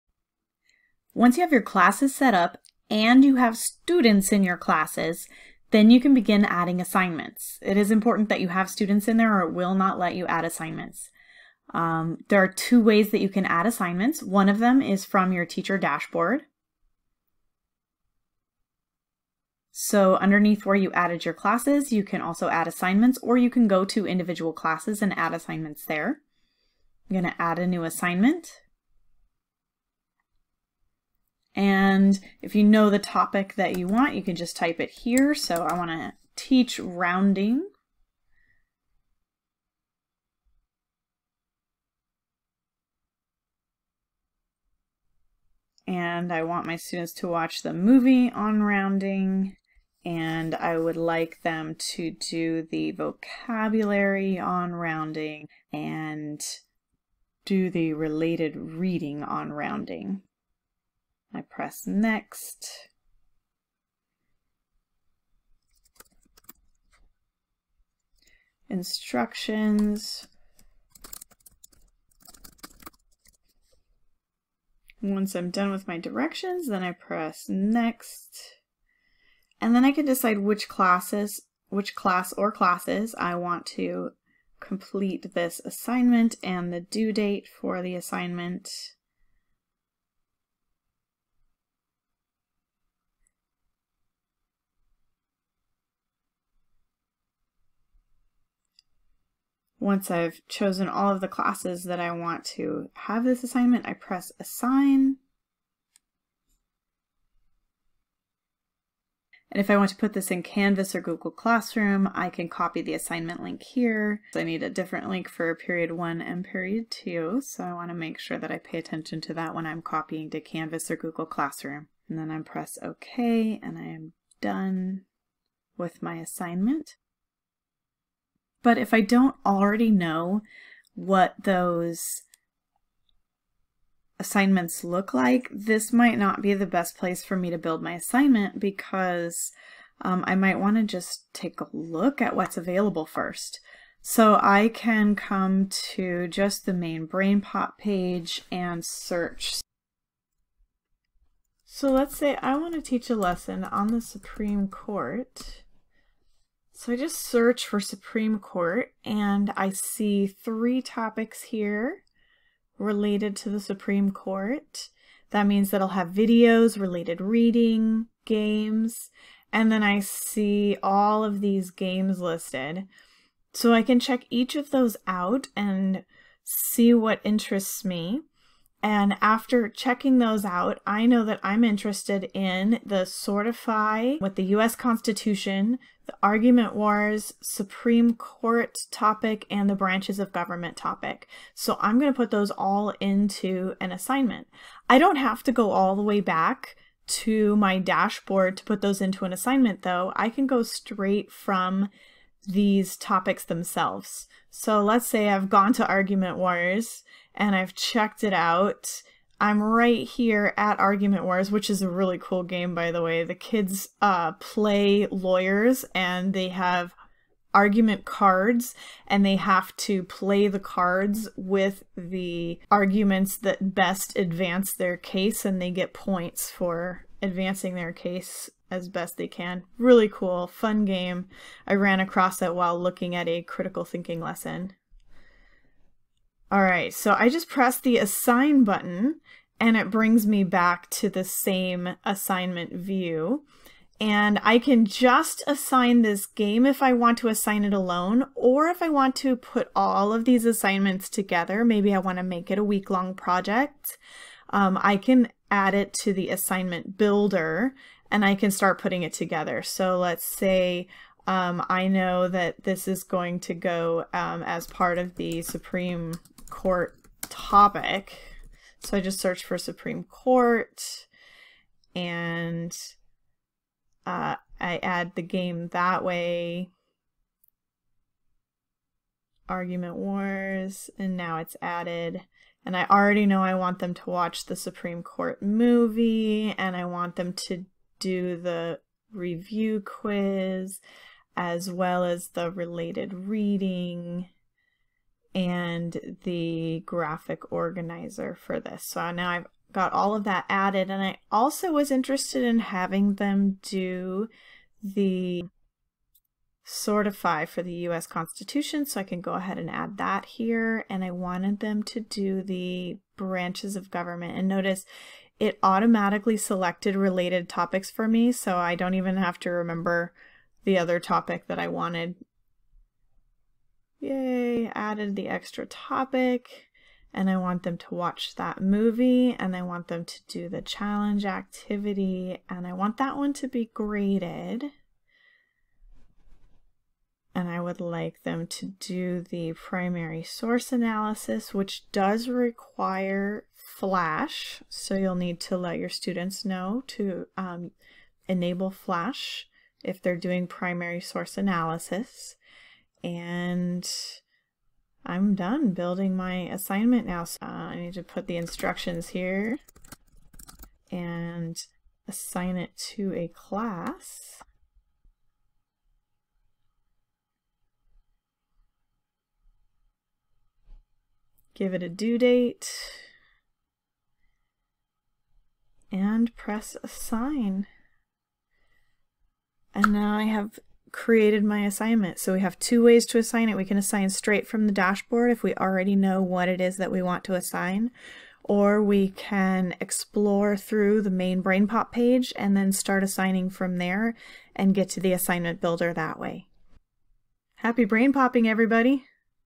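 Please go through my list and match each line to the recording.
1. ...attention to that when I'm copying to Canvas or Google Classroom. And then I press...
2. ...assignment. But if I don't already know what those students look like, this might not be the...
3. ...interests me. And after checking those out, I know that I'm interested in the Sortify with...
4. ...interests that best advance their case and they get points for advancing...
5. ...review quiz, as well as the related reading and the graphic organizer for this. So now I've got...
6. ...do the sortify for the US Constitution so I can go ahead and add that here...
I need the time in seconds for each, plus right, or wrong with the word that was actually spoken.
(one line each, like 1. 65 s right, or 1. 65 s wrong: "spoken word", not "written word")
1. 118 s right
2. 126 s wrong: "assignments", not "students"
3. 177 s right
4. 222 s wrong: "arguments", not "interests"
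5. 289 s right
6. 303 s right.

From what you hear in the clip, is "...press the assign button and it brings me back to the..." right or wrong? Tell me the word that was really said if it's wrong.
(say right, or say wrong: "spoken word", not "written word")
right.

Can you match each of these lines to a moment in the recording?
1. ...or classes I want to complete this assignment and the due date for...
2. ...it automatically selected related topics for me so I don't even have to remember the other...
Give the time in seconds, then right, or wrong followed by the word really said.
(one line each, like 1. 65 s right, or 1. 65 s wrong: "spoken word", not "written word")
1. 82 s right
2. 315 s right.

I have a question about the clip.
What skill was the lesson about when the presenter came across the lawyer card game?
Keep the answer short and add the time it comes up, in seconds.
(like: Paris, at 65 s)
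Critical thinking, at 233 s.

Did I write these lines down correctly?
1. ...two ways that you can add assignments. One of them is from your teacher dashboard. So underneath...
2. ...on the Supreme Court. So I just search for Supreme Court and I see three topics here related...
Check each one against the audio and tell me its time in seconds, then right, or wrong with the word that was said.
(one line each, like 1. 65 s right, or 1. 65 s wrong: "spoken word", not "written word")
1. 12 s right
2. 153 s right.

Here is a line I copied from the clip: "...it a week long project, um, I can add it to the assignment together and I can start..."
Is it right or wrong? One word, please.
wrong.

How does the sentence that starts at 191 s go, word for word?
So I'm going to put those all into an assignment.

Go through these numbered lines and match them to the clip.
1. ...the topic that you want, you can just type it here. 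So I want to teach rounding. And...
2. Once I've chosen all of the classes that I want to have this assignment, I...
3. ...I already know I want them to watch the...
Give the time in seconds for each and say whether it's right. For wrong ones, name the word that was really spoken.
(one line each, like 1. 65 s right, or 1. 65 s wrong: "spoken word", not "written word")
1. 32 s right
2. 99 s right
3. 282 s right.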